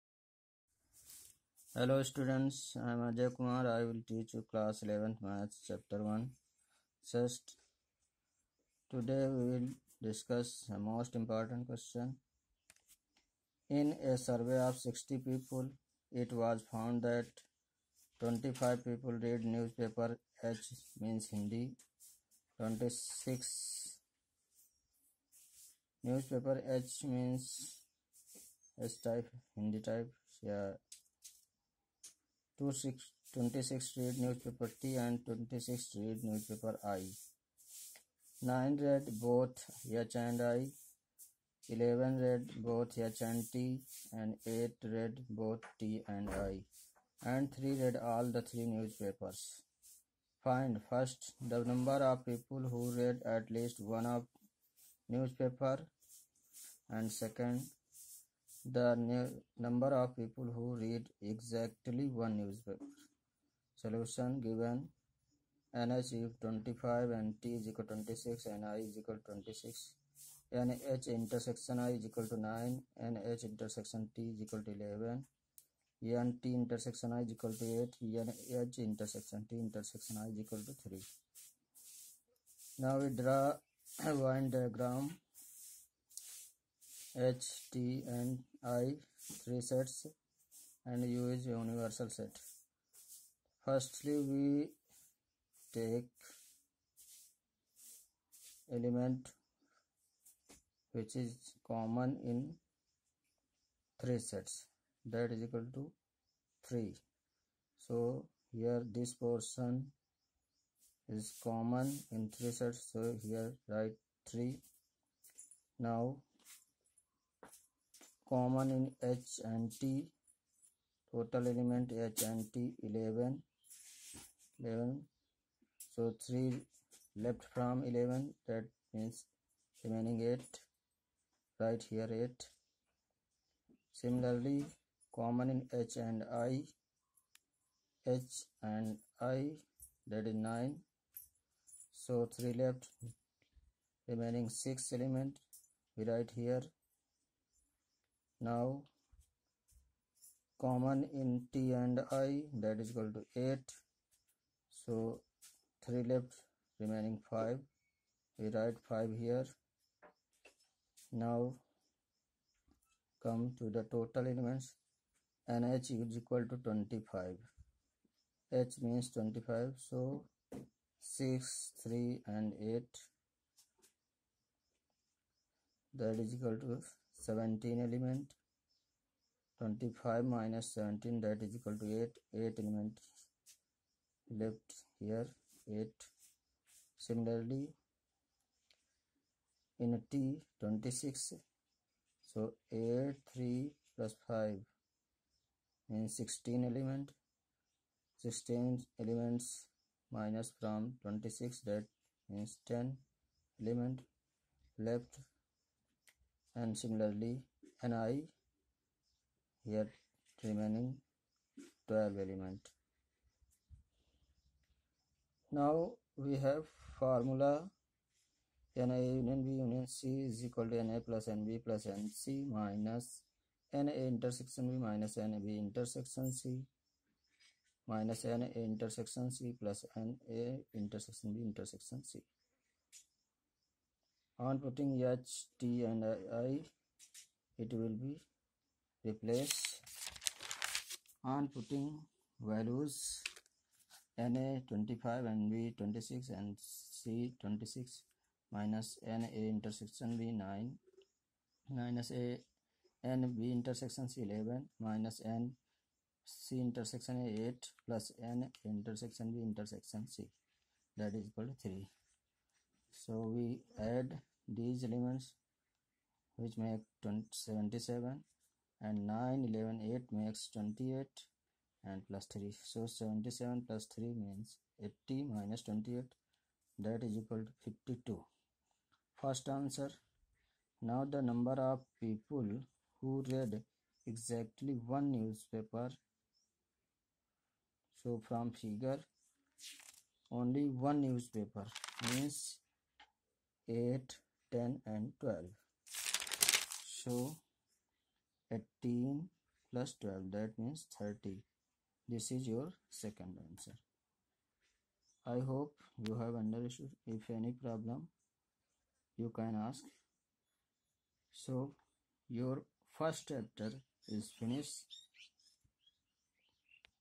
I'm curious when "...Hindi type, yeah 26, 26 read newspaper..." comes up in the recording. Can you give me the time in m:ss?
0:29.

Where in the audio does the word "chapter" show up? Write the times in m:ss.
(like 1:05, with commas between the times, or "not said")
0:05, 5:13.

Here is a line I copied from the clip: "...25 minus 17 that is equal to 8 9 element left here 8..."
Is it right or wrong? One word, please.
wrong.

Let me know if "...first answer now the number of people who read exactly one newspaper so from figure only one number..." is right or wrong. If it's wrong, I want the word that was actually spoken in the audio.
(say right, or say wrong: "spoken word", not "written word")
wrong: "newspaper", not "number".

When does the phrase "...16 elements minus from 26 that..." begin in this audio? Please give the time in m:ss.
3:18.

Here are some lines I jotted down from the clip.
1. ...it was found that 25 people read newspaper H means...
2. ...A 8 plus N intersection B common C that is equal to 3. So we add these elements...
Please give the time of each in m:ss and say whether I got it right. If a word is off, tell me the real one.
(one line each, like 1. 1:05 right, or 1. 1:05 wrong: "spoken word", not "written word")
1. 0:16 right
2. 4:17 wrong: "intersection", not "common".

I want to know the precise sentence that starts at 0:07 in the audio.
First, today we will discuss a most important question.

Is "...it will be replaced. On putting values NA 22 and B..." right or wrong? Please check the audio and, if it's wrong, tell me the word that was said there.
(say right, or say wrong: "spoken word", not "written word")
wrong: "25", not "22".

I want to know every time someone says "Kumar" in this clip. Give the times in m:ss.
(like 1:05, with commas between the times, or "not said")
0:03.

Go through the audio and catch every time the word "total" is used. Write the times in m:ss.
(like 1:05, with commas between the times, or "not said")
2:01, 2:43.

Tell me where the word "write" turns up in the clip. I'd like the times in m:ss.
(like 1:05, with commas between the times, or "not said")
1:53, 2:26, 2:38.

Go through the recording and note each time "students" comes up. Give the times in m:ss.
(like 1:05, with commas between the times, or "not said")
0:02.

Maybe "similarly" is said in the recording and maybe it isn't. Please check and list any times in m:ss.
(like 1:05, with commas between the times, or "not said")
2:14, 3:07, 3:26.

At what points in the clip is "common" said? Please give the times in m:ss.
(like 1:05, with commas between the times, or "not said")
1:41, 1:51, 1:58, 2:15, 2:30.